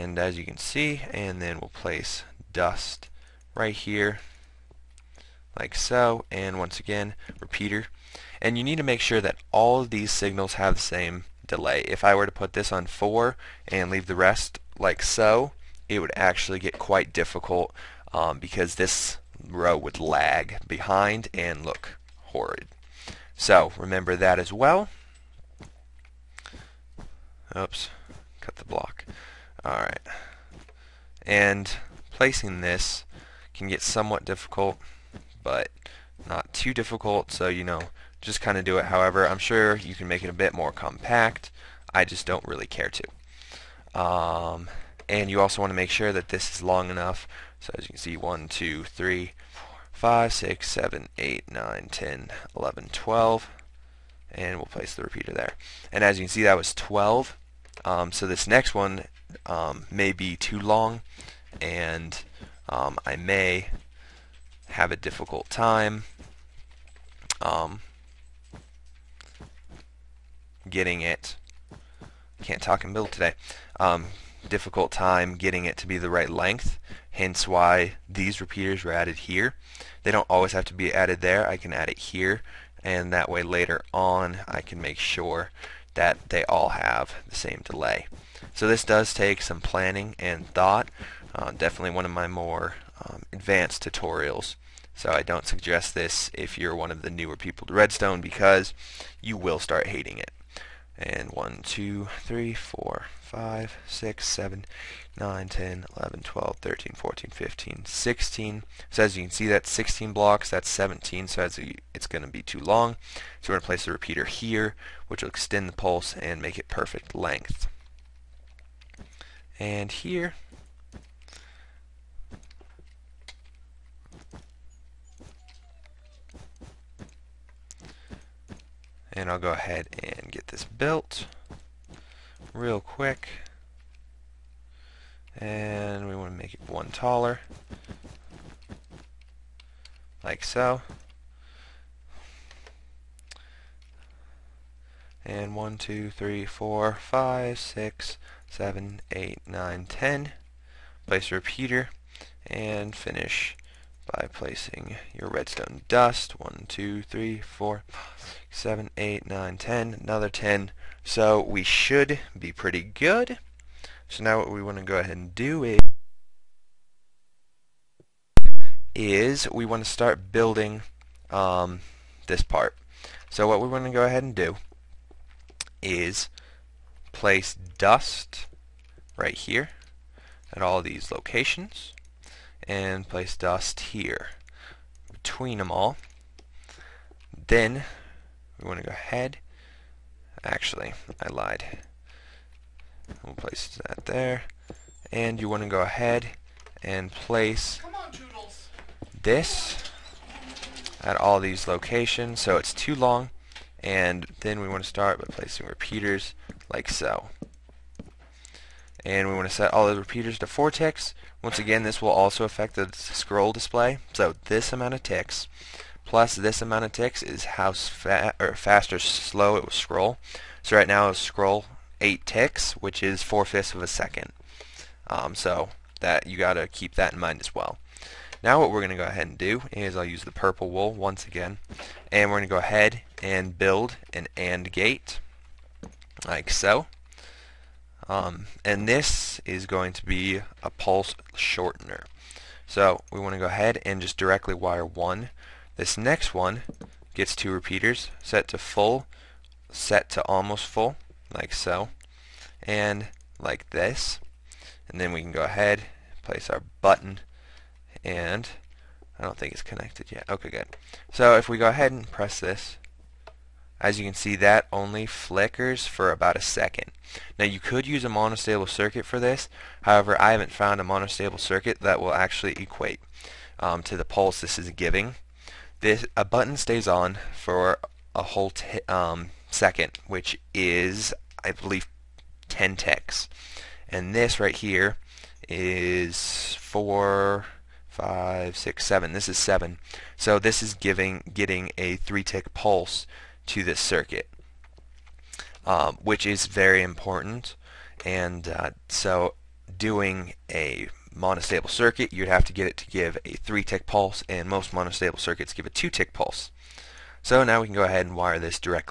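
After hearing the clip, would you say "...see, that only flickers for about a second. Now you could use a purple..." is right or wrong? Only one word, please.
wrong.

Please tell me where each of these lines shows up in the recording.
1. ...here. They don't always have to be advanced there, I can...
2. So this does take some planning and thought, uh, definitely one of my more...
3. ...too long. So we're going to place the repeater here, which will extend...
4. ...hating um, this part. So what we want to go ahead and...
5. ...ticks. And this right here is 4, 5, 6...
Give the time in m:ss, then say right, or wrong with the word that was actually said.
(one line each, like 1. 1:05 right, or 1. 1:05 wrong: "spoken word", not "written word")
1. 1:19 wrong: "added", not "advanced"
2. 1:28 right
3. 1:52 right
4. 2:50 wrong: "building", not "hating"
5. 4:42 right.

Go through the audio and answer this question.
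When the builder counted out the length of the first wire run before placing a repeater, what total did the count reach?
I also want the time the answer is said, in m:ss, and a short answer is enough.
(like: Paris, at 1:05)
12, at 0:55.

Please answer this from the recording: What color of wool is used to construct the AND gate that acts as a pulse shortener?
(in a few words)
purple.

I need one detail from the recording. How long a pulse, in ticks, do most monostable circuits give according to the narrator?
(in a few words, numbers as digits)
2-tick.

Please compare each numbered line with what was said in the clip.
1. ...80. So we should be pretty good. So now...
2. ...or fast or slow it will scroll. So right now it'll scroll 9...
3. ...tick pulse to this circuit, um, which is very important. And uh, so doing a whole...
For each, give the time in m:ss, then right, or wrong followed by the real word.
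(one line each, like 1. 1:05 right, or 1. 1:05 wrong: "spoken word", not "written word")
1. 2:40 wrong: "10", not "80"
2. 3:38 wrong: "8", not "9"
3. 4:52 wrong: "monostable", not "whole".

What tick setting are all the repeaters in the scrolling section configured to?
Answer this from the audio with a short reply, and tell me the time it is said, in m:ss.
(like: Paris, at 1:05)
4 ticks, at 3:30.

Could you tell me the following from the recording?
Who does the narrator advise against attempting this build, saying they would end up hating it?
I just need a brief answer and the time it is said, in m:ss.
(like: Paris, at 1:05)
newer people to Redstone, at 1:37.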